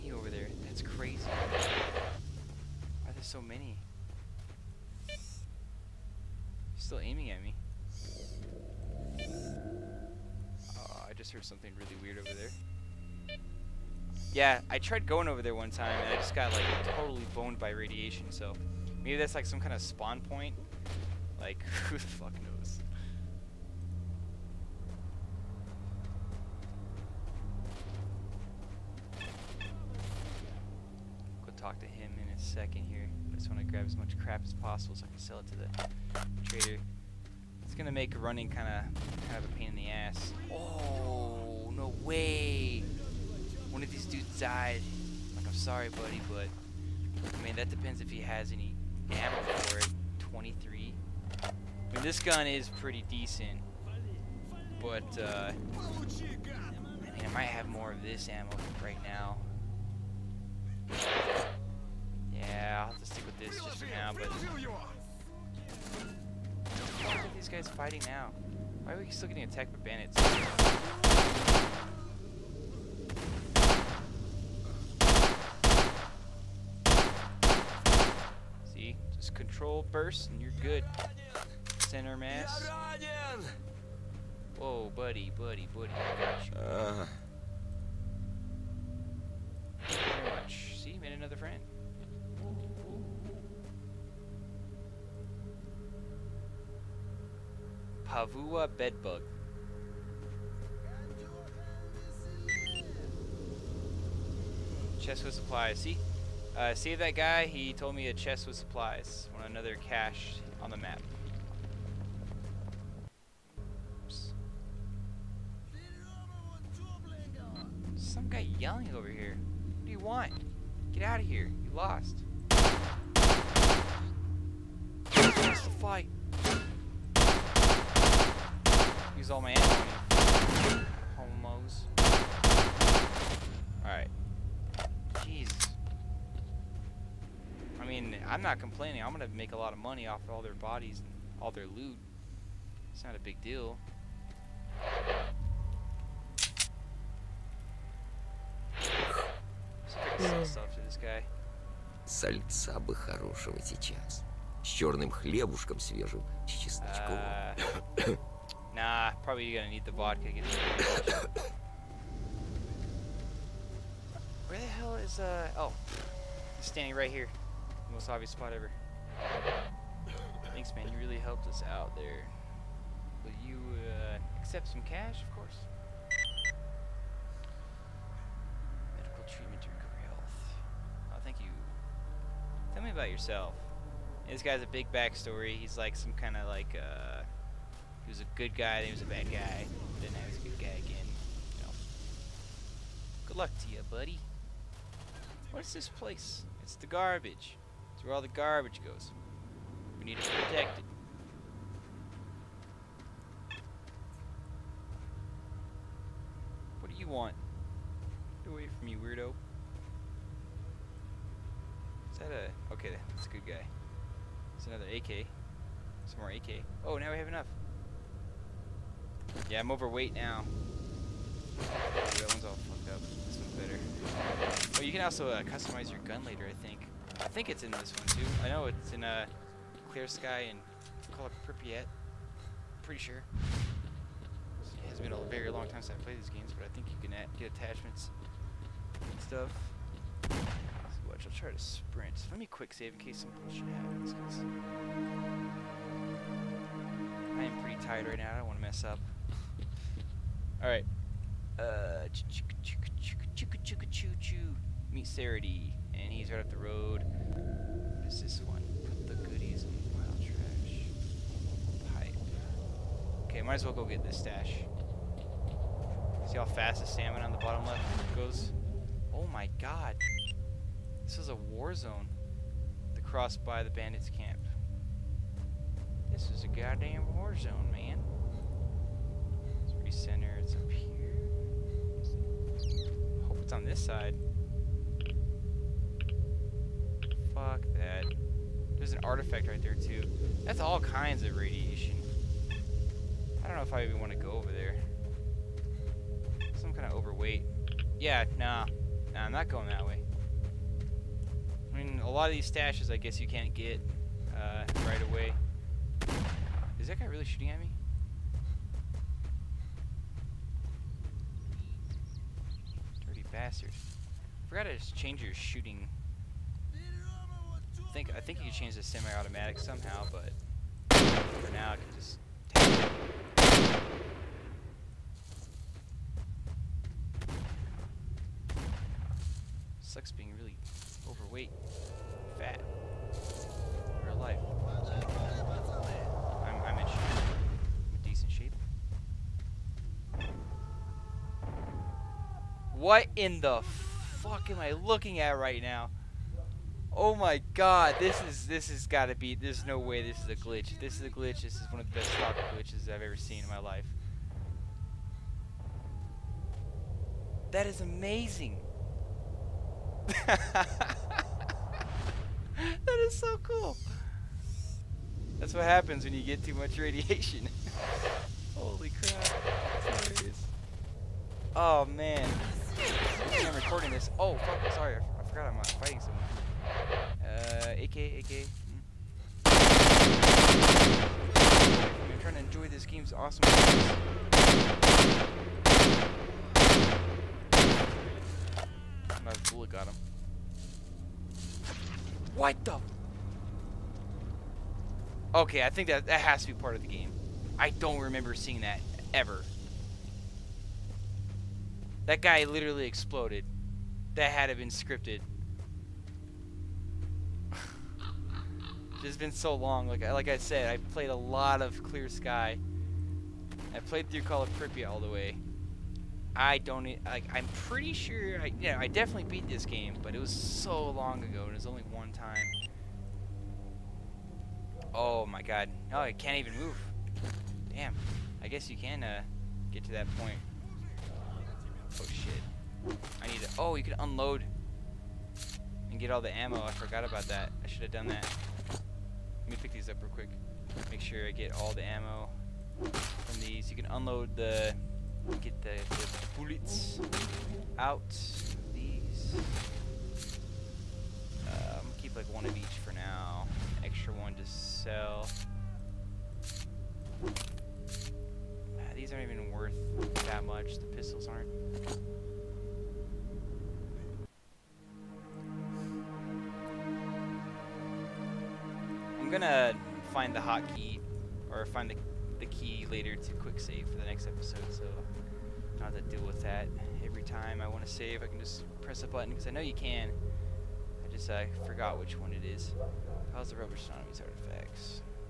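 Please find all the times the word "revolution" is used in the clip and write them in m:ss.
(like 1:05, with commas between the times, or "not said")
not said.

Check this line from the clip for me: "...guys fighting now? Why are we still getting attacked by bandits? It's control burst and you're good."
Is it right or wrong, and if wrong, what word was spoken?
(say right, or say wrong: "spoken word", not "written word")
right.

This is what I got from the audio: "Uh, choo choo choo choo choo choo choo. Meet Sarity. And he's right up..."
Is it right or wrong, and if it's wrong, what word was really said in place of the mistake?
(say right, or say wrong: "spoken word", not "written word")
right.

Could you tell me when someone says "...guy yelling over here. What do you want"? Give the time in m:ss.
1:58.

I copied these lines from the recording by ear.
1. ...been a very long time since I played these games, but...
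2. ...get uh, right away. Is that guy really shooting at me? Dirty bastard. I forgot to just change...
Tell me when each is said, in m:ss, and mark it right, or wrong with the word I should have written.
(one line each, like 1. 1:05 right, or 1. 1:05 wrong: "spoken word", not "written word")
1. 3:54 right
2. 5:03 right.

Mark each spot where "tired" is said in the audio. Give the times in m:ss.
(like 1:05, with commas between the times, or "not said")
4:07.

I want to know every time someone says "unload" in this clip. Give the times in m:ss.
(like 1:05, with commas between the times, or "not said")
7:13, 7:23.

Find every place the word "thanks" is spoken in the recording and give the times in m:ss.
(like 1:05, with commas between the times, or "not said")
2:50, 3:01.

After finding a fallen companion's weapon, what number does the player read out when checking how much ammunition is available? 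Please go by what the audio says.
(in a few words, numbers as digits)
23.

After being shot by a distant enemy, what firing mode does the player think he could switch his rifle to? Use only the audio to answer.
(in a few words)
semi-automatic.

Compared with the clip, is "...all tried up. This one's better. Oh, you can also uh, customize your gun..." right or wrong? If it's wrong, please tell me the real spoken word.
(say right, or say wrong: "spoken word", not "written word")
wrong: "fucked", not "tried".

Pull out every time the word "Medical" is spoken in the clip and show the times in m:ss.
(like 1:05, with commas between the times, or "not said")
2:58.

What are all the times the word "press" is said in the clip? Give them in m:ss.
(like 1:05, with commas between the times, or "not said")
7:58.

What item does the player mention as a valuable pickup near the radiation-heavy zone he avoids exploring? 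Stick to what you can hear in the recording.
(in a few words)
an artifact.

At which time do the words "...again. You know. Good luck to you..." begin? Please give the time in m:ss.
3:10.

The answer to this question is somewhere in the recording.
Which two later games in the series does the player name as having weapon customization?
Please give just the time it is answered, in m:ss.
3:49.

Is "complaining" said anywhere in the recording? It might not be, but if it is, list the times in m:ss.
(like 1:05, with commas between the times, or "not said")
2:18.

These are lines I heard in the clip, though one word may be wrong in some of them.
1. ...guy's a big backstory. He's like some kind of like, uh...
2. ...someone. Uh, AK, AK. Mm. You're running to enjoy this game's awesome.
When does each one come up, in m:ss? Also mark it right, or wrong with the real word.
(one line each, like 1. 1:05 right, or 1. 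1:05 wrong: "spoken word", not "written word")
1. 3:04 right
2. 6:15 wrong: "trying", not "running".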